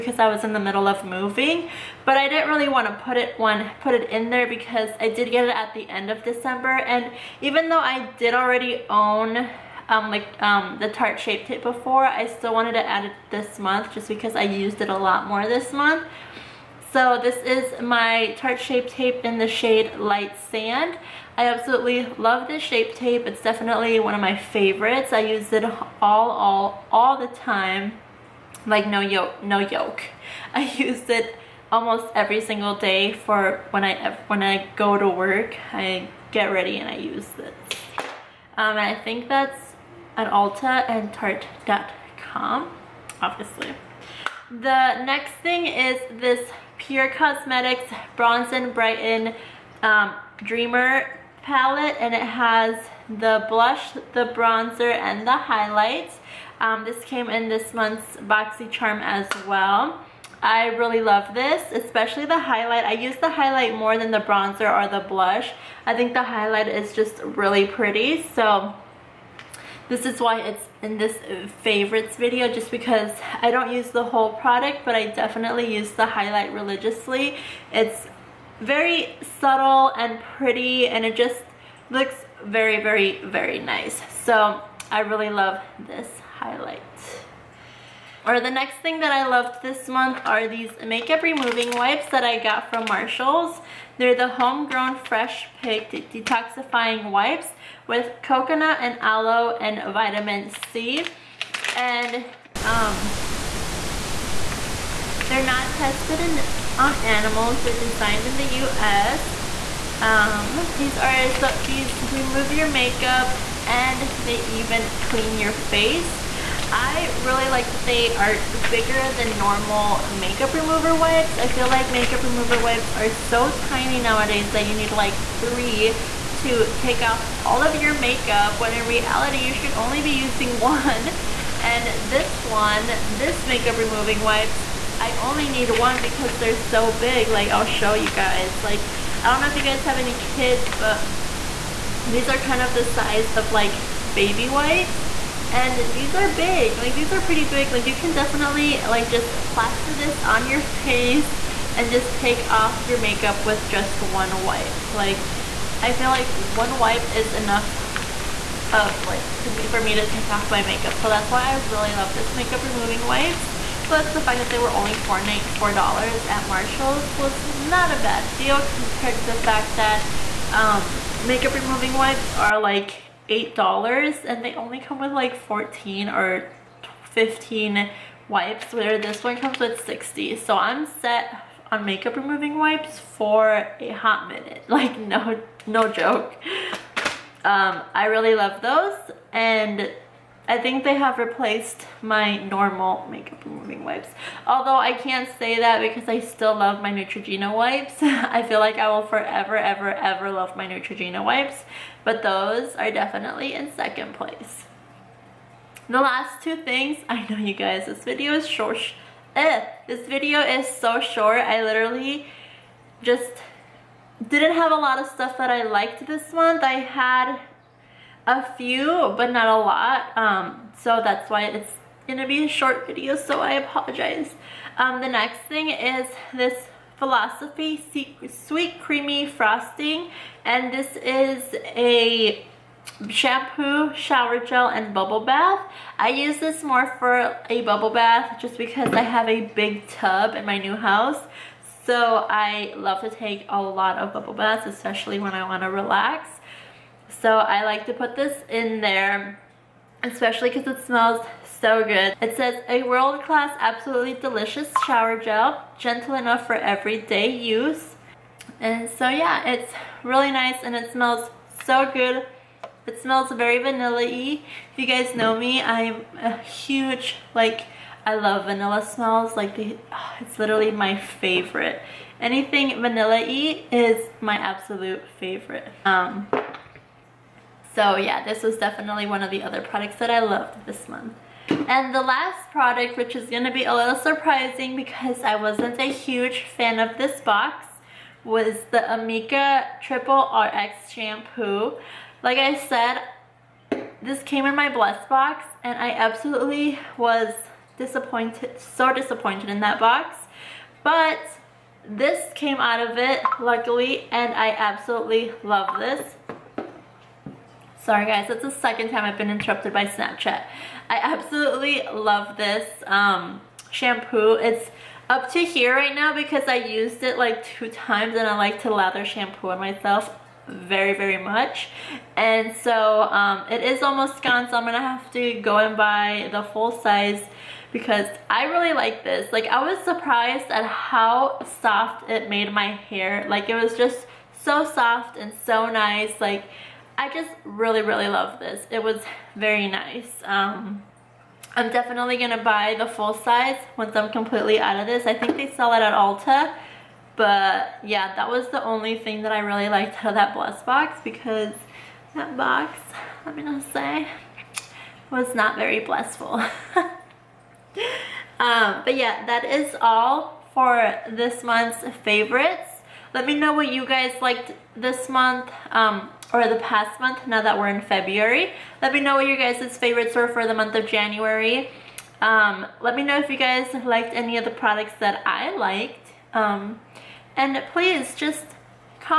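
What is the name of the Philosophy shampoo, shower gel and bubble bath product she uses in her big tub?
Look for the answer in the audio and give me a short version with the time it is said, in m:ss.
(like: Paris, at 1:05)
Sweet Creamy Frosting, at 3:48.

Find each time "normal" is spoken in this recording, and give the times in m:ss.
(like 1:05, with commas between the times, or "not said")
1:59, 3:12.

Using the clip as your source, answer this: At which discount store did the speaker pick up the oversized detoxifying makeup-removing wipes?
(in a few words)
Marshalls.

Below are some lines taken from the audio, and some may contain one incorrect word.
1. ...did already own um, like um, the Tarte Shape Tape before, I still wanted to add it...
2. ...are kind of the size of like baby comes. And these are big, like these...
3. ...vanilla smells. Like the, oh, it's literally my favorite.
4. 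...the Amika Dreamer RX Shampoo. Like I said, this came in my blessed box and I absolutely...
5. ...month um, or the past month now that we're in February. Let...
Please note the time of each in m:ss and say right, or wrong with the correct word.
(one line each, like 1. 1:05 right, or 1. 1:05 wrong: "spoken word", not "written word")
1. 0:08 right
2. 2:22 wrong: "wipes", not "comes"
3. 4:28 right
4. 4:48 wrong: "Triple", not "Dreamer"
5. 6:05 right.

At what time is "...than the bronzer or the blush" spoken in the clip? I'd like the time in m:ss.
1:03.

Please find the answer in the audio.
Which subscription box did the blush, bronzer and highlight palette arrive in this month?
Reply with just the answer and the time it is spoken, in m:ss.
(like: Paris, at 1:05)
BoxyCharm, at 0:58.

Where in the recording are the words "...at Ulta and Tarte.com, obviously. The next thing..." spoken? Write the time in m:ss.
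0:40.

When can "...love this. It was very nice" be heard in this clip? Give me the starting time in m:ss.
5:38.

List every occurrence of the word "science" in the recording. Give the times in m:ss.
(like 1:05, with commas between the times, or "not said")
not said.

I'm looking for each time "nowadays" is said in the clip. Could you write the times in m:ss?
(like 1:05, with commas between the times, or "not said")
2:04.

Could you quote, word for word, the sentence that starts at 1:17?
It's very subtle and pretty and it just looks very very very nice.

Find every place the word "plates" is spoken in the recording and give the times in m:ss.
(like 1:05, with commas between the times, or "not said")
not said.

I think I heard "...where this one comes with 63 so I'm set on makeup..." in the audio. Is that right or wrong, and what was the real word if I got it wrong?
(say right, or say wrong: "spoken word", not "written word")
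wrong: "60", not "63".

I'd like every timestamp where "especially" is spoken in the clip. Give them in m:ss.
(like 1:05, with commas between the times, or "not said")
1:01, 4:04, 4:10.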